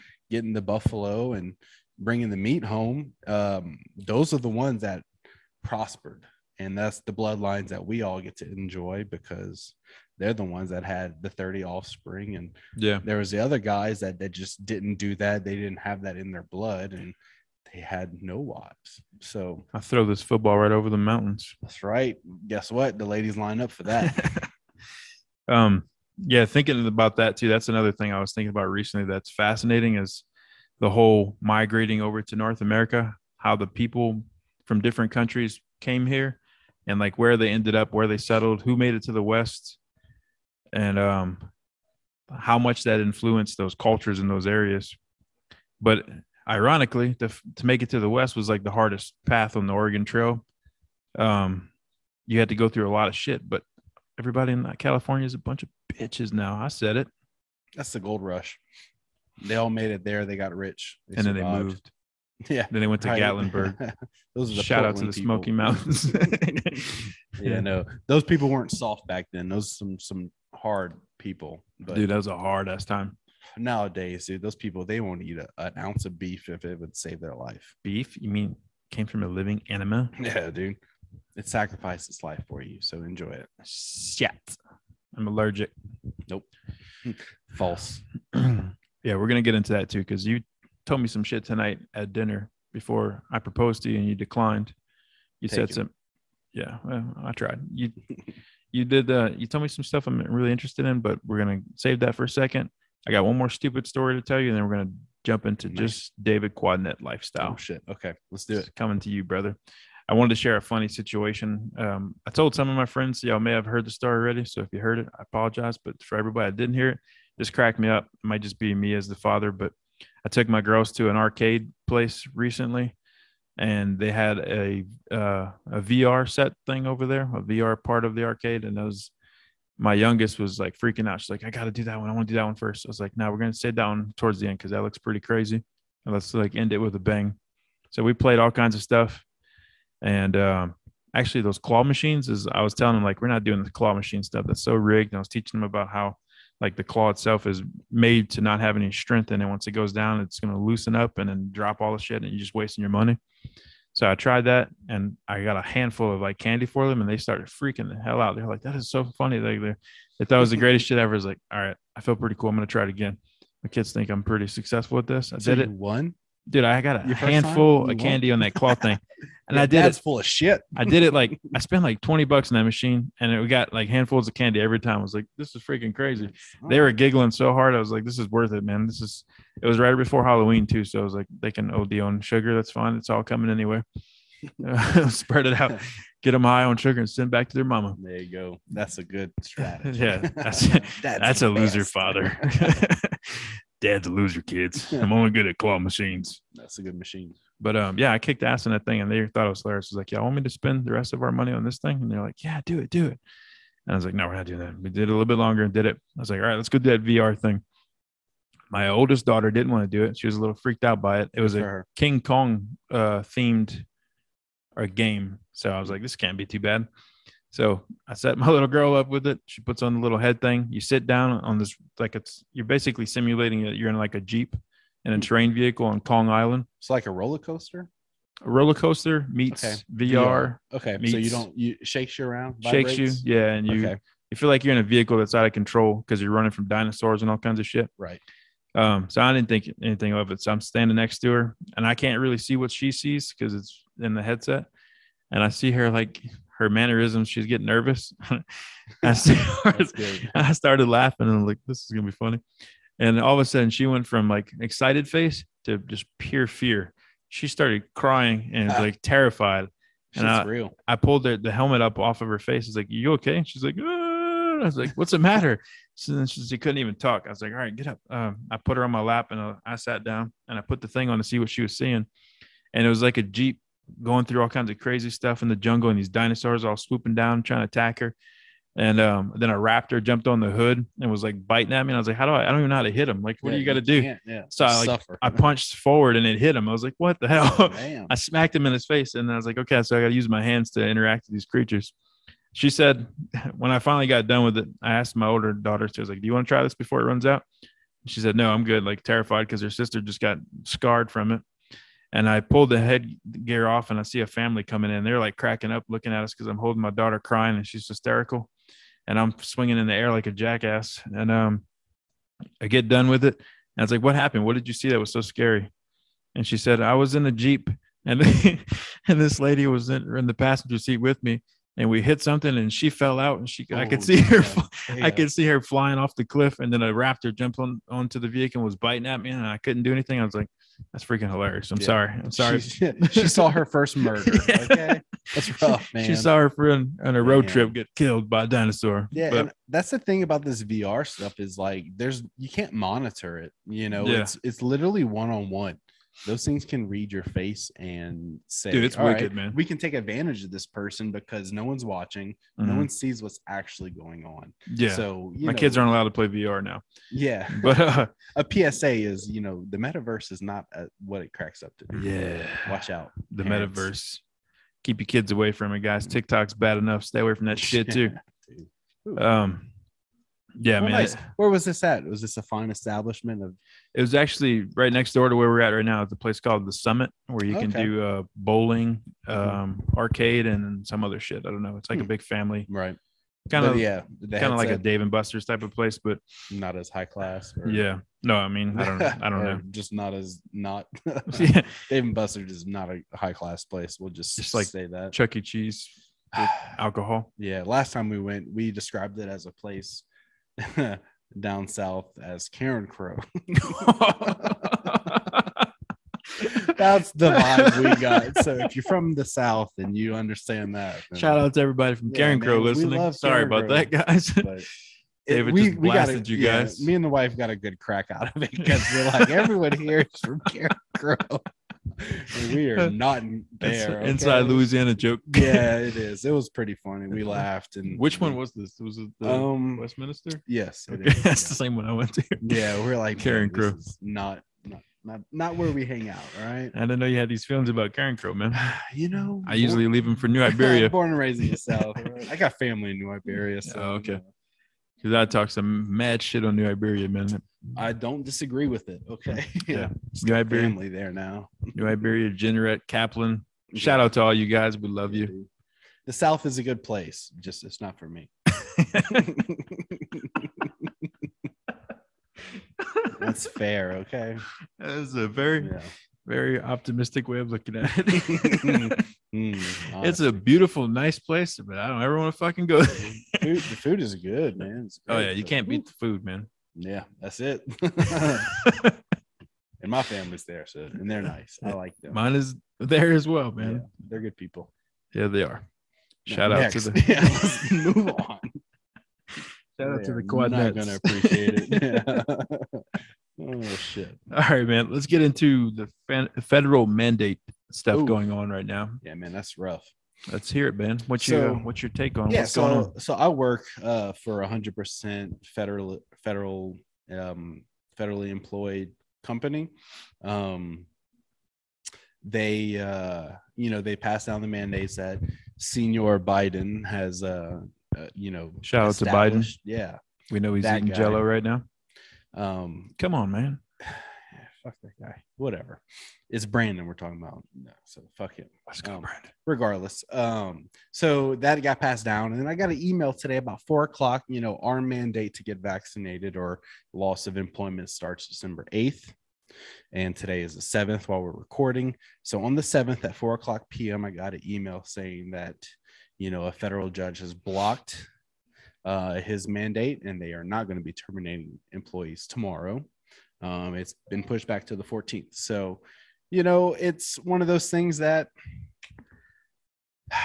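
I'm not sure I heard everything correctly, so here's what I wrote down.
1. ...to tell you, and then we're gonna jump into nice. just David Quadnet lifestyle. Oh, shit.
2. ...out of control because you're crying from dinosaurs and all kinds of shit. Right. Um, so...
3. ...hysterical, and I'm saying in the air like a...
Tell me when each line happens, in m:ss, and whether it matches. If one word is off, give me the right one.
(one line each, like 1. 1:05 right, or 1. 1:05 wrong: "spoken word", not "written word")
1. 1:44 right
2. 3:55 wrong: "running", not "crying"
3. 5:07 wrong: "swinging", not "saying".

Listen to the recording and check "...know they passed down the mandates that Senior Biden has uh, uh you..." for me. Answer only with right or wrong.
right.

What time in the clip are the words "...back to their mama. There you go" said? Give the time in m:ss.
3:07.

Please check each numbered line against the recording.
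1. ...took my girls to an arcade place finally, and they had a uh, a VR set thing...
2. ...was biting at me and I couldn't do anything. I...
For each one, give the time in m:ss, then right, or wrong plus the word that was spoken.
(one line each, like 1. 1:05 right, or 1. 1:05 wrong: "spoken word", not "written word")
1. 2:00 wrong: "recently", not "finally"
2. 5:28 right.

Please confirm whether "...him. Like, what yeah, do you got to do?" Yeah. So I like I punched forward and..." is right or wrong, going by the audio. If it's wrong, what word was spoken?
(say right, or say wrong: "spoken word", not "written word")
right.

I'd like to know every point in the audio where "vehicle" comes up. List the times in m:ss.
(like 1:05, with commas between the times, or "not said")
3:45, 3:54, 5:28.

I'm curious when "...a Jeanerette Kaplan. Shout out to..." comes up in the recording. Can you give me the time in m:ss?
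7:32.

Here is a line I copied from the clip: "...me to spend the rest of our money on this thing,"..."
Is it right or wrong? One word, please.
right.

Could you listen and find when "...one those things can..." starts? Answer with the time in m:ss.
5:45.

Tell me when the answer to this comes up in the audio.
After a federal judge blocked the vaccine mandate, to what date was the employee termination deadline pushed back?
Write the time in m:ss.
9:14.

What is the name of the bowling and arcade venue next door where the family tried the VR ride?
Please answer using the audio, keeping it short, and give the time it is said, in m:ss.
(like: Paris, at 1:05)
the Summit, at 6:16.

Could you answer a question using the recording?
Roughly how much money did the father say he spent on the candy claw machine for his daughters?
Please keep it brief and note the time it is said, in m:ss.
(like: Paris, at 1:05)
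20 bucks, at 2:52.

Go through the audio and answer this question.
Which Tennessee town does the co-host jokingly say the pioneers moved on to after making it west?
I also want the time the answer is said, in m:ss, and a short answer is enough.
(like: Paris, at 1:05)
Gatlinburg, at 1:03.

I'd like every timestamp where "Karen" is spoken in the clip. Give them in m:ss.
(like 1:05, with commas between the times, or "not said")
6:52, 7:00.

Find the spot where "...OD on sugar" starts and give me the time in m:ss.
3:01.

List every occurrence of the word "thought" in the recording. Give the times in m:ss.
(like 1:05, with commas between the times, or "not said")
2:40, 3:19.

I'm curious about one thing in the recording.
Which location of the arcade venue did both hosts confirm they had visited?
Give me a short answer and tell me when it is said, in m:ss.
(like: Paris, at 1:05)
Westminster, at 7:09.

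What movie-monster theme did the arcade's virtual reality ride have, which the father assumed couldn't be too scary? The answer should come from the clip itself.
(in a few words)
King Kong.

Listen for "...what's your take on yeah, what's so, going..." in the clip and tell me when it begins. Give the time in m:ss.
8:21.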